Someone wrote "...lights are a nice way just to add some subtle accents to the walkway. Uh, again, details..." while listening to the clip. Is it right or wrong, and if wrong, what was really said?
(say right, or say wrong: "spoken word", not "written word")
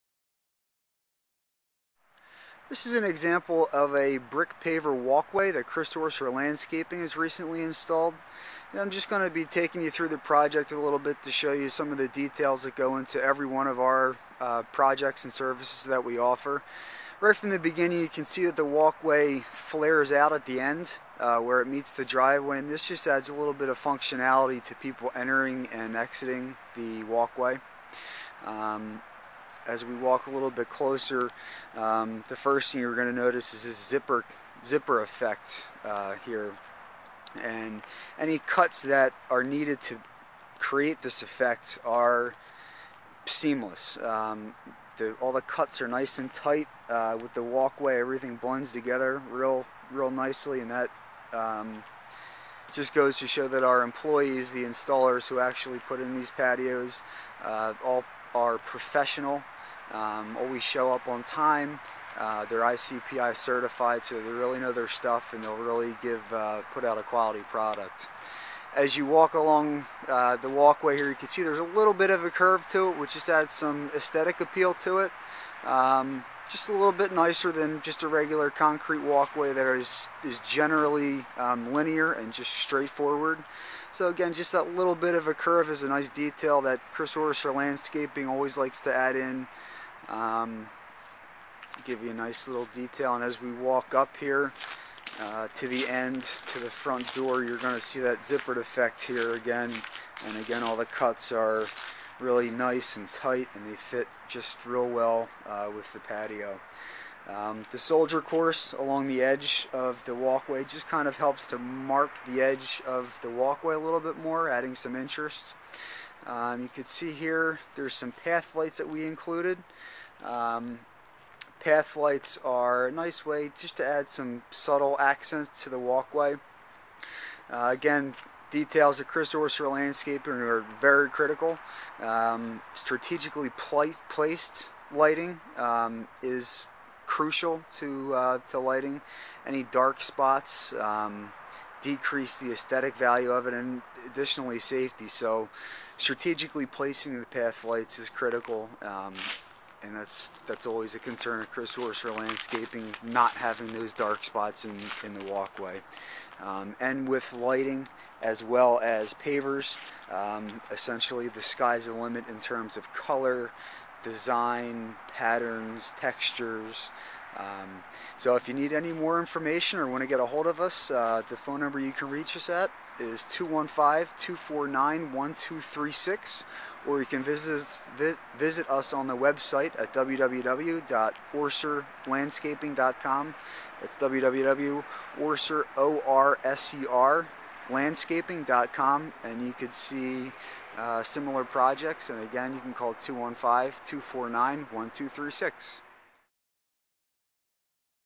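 right.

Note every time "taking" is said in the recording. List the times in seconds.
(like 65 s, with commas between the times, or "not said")
9 s.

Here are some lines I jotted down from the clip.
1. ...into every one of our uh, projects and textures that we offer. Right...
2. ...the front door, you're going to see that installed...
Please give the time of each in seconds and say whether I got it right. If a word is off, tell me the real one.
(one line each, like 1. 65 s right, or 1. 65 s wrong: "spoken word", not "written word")
1. 12 s wrong: "services", not "textures"
2. 96 s wrong: "zippered", not "installed".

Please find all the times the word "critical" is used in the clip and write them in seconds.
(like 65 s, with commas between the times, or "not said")
131 s, 148 s.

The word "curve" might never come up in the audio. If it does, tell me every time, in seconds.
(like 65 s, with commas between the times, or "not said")
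72 s, 85 s.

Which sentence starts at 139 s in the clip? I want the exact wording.
Any dark spots um, decrease the aesthetic value of it, and additionally safety.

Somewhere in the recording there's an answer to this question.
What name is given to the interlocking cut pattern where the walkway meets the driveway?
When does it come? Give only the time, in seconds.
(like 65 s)
33 s.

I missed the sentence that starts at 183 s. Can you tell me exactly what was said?
That's www.orser, O-R-S-E-R, landscaping.com and you could see uh, similar projects and again you can call 215-249-1236.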